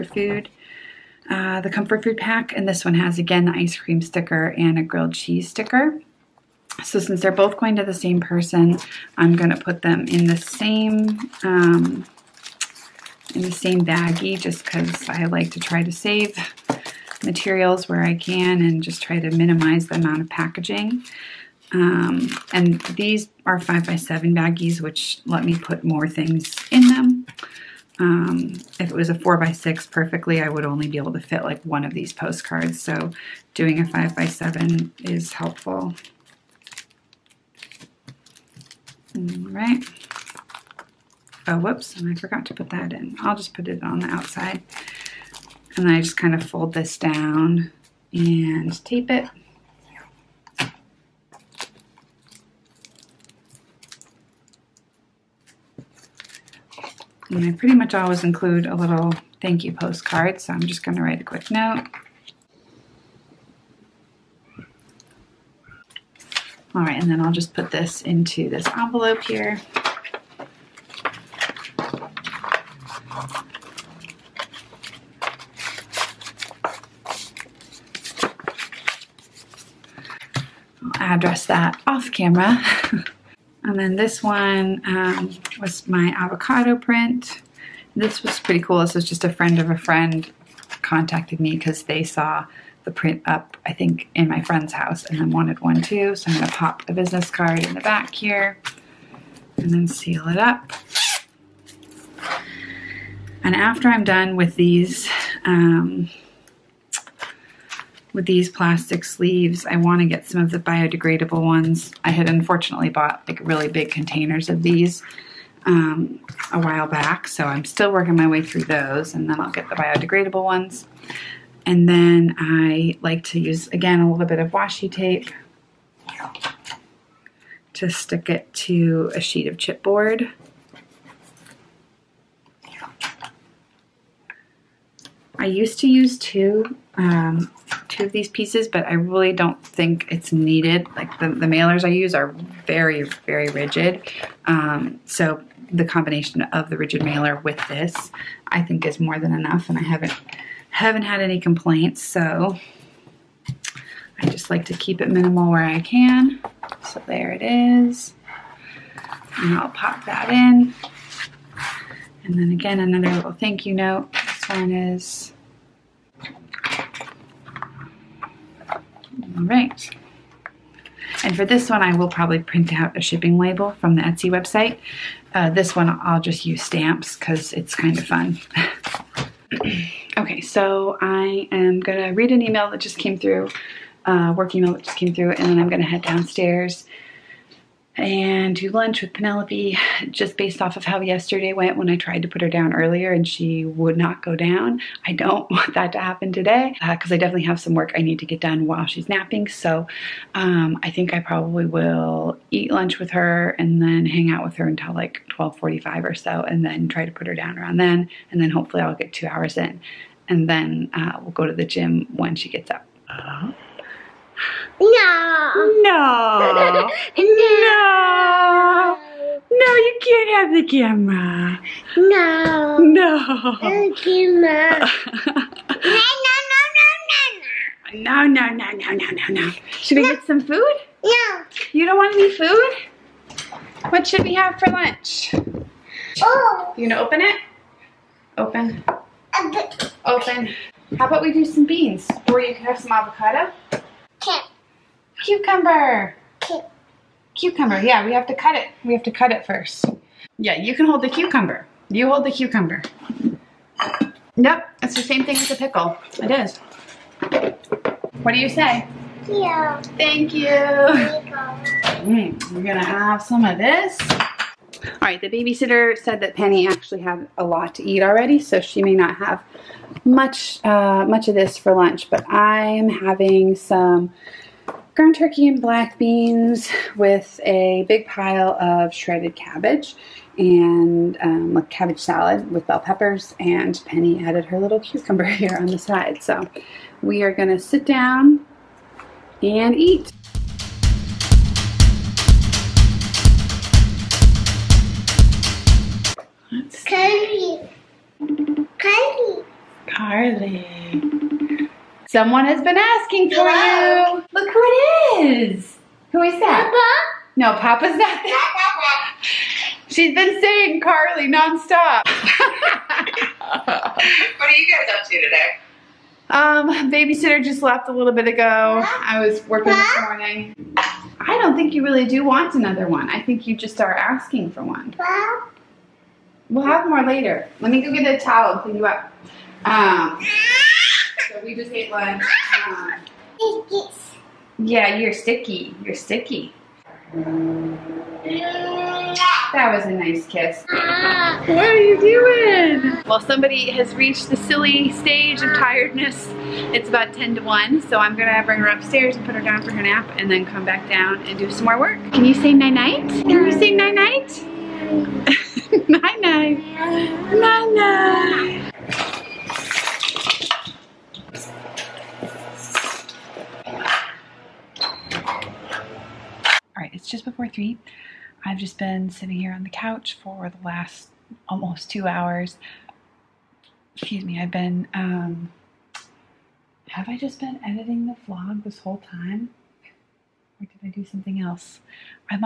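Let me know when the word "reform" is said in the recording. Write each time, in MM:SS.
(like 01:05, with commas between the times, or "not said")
not said.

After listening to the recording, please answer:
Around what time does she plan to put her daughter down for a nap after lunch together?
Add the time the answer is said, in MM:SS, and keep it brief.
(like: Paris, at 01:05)
12:45, at 03:25.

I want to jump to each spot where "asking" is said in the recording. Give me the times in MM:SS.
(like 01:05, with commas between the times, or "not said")
05:02, 05:23.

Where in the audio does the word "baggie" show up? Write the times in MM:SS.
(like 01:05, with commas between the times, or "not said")
00:13, 00:24.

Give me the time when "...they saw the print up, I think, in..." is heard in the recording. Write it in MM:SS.
01:31.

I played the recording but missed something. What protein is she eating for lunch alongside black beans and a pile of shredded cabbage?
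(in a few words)
ground turkey.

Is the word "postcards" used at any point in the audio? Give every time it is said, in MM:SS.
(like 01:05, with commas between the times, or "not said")
00:32, 00:59.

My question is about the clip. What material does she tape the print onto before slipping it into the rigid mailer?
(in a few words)
chipboard.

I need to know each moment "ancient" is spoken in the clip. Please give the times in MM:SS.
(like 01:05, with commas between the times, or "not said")
not said.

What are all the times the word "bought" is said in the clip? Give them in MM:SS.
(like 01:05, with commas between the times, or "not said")
01:52.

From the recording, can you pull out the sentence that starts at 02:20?
Like the, the mailers I use are very, very rigid.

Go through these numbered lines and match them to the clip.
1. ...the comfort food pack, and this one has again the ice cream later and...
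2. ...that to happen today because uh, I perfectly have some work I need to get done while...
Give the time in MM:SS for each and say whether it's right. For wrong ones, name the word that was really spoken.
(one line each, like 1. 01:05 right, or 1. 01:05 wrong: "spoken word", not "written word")
1. 00:01 wrong: "sticker", not "later"
2. 03:15 wrong: "definitely", not "perfectly".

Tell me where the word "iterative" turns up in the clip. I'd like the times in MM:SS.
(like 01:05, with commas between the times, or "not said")
not said.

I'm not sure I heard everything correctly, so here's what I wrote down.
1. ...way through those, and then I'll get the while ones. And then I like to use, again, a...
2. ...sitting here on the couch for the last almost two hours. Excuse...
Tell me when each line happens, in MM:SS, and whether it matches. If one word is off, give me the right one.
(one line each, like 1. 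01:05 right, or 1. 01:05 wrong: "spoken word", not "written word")
1. 01:58 wrong: "biodegradable", not "while"
2. 06:09 right.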